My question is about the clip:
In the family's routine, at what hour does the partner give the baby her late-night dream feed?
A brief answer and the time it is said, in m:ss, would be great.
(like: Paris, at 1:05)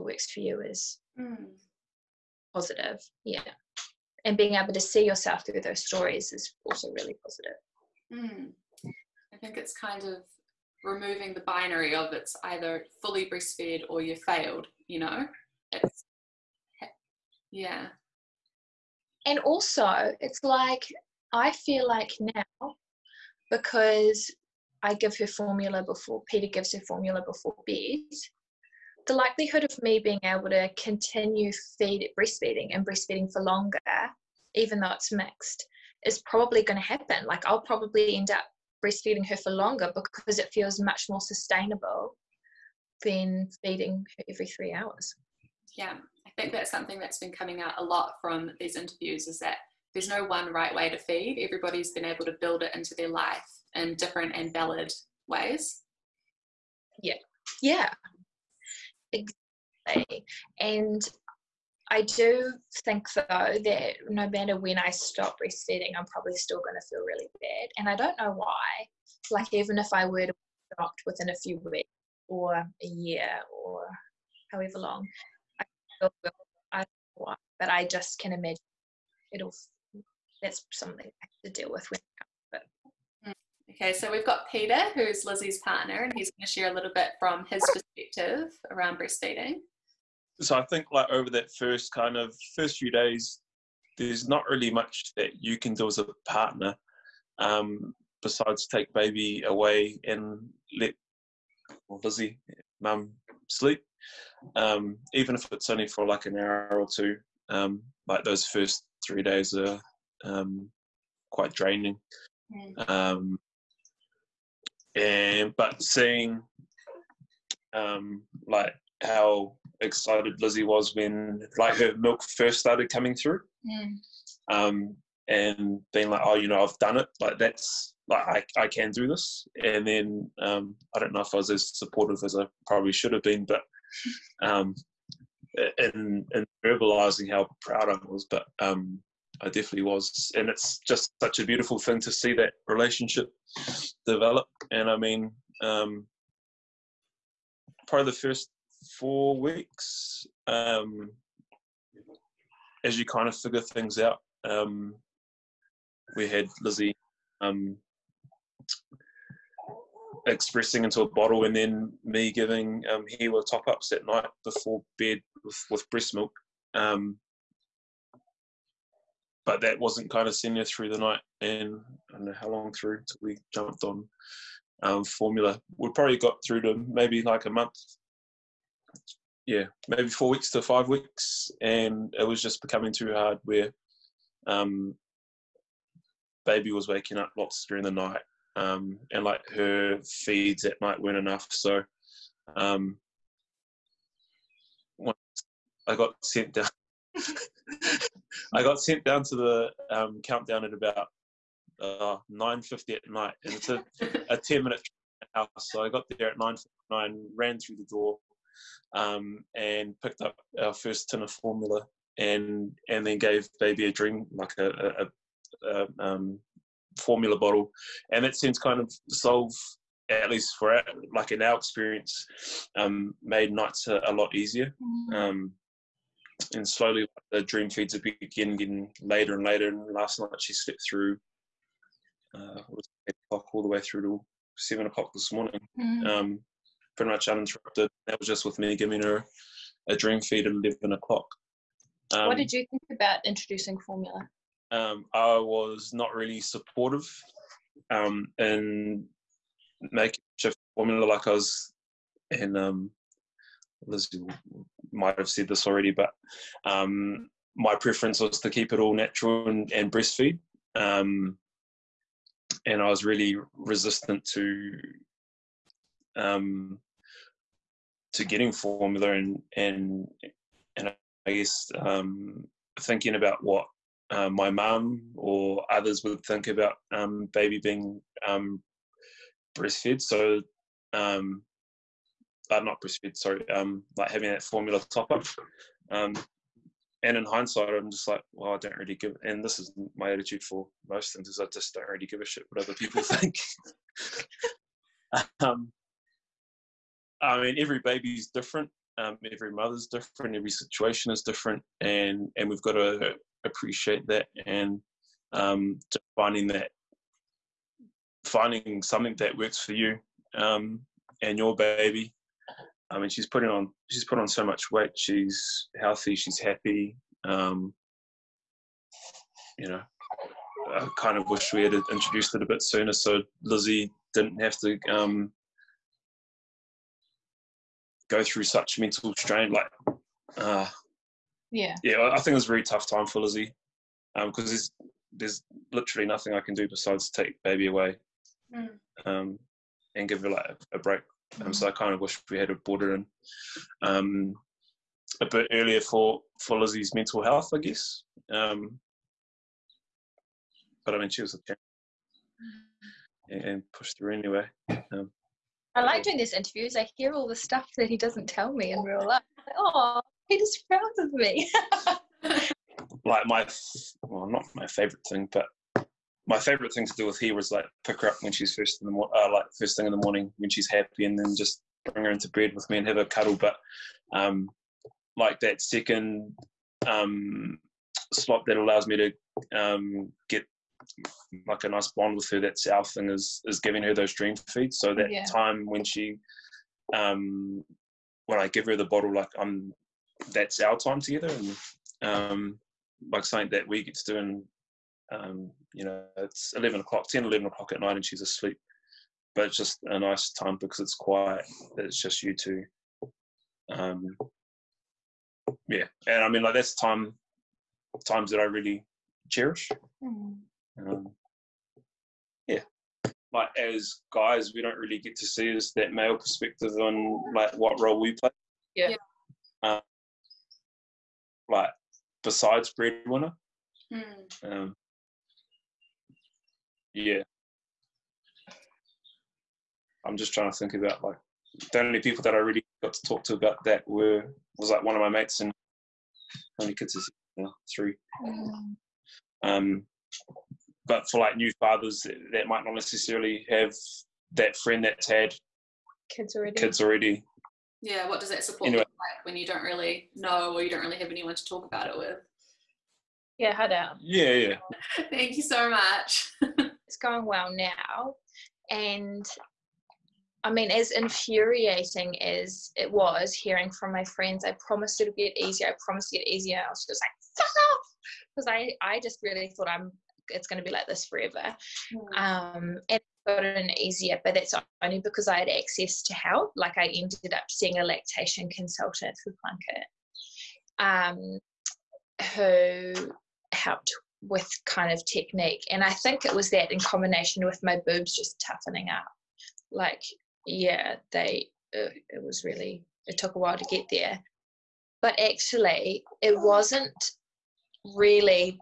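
11 o'clock, at 4:00.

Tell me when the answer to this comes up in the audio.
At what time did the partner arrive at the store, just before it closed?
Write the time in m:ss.
3:26.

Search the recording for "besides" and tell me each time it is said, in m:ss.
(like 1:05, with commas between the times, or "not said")
1:38, 5:36, 7:02.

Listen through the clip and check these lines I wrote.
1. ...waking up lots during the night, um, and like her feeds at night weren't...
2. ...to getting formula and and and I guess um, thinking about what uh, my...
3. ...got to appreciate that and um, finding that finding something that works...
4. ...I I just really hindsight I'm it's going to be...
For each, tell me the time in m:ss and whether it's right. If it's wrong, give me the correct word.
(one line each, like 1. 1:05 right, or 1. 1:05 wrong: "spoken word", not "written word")
1. 3:06 right
2. 4:28 right
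3. 5:02 right
4. 7:48 wrong: "thought", not "hindsight".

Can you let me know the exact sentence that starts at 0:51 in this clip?
Everybody's been able to build it into their life in different and valid ways.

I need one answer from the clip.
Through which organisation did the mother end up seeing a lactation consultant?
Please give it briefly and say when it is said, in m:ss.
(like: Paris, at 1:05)
Plunkett, at 7:59.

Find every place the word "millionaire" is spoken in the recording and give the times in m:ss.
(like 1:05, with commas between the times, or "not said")
not said.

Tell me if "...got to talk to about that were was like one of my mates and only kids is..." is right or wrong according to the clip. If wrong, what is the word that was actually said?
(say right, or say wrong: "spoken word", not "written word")
right.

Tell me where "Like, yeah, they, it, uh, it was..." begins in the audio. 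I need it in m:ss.
8:09.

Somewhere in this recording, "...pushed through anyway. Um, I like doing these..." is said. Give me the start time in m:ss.
5:53.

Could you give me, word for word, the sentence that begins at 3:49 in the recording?
And last night she slept through uh, eight o'clock all the way through to seven o'clock this morning, mm.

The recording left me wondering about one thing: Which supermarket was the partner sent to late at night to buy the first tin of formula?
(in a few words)
Countdown.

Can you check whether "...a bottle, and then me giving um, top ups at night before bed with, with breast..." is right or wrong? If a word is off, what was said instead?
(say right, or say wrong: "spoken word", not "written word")
right.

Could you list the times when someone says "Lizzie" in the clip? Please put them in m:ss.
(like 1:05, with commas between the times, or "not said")
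1:25, 1:42, 2:00, 2:36, 4:13, 5:23, 5:33, 5:46.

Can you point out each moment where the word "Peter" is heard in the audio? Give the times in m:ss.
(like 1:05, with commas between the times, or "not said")
0:26, 1:24.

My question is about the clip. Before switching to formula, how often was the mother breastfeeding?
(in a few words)
every 3 hours.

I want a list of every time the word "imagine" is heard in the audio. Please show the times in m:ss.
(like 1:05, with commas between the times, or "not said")
1:18.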